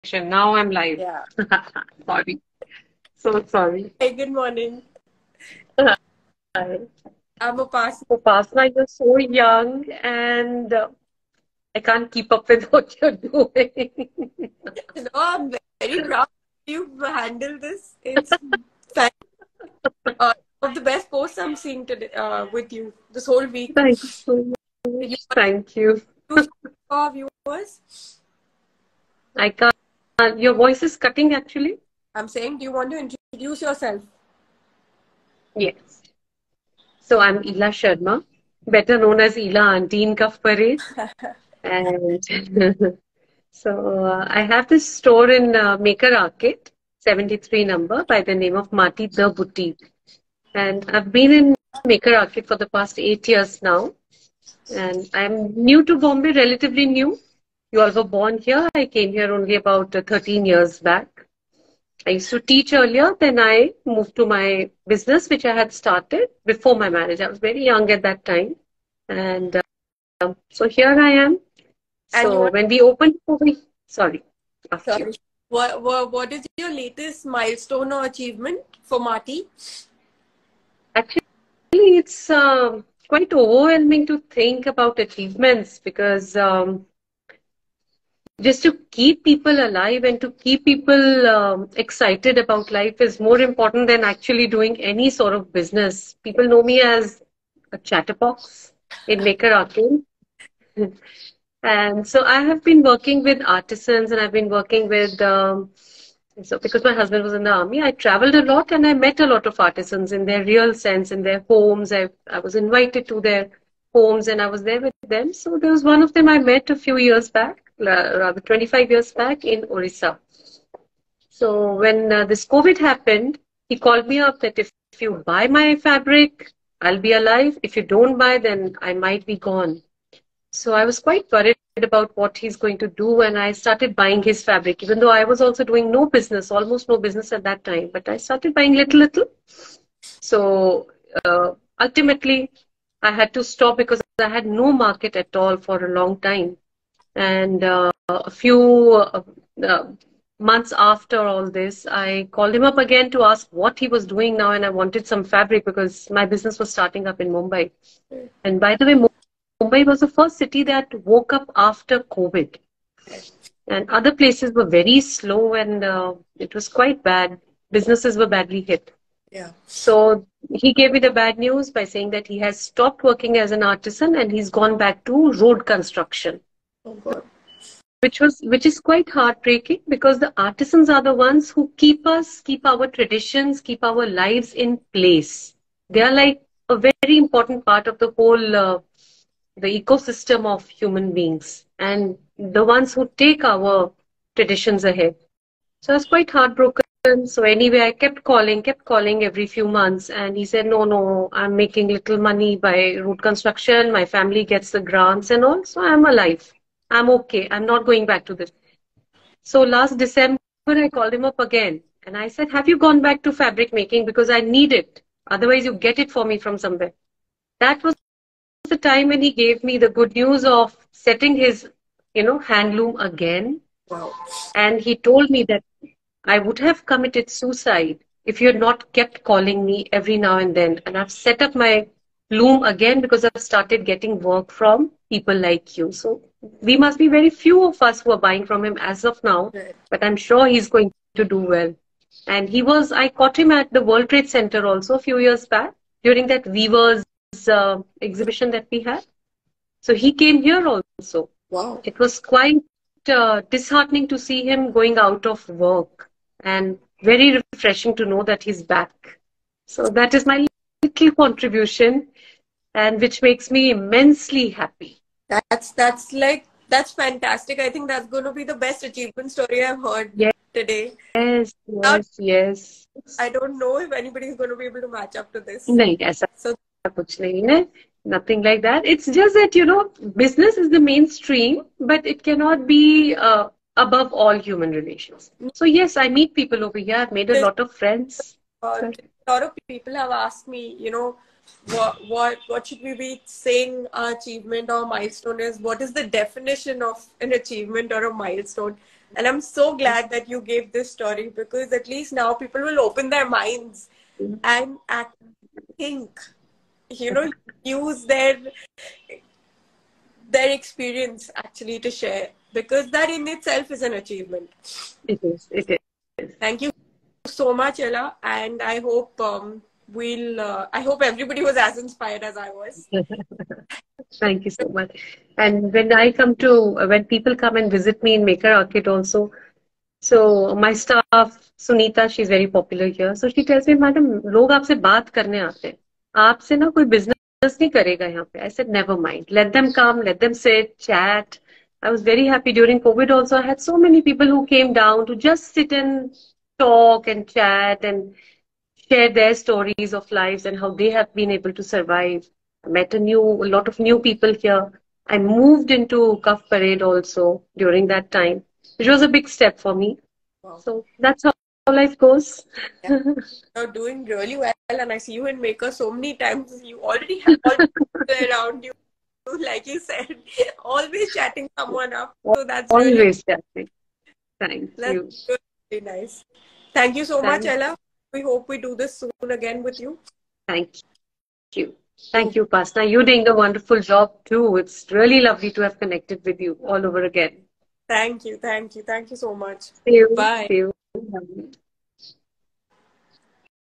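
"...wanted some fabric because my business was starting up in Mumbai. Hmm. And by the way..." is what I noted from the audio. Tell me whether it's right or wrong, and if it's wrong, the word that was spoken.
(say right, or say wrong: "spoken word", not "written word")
right.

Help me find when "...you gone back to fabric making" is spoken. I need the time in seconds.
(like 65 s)
212 s.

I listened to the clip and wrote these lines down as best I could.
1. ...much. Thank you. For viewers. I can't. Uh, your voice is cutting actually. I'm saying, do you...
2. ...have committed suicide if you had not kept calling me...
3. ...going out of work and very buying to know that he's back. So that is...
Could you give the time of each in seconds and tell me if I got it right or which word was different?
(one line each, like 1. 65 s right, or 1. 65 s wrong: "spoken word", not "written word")
1. 24 s right
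2. 226 s right
3. 254 s wrong: "refreshing", not "buying".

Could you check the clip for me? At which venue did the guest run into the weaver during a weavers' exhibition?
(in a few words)
World Trade Center.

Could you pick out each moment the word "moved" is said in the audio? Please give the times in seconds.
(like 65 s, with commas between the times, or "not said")
63 s, 355 s.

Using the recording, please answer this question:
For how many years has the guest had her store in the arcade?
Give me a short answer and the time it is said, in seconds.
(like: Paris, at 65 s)
8, at 52 s.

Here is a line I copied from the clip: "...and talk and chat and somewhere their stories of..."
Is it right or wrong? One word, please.
wrong.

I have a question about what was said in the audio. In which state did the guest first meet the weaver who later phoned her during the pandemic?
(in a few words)
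Orissa.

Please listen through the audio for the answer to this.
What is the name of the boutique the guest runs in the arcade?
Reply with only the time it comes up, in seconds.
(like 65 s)
48 s.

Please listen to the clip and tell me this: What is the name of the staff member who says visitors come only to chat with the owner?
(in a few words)
Sunita.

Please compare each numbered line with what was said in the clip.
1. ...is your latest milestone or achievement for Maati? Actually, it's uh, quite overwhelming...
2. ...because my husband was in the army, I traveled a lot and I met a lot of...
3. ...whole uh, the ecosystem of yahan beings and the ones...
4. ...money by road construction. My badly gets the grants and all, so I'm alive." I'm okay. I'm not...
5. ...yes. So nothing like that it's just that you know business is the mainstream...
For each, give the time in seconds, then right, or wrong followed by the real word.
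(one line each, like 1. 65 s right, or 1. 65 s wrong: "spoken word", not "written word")
1. 76 s right
2. 106 s right
3. 188 s wrong: "human", not "yahan"
4. 202 s wrong: "family", not "badly"
5. 275 s right.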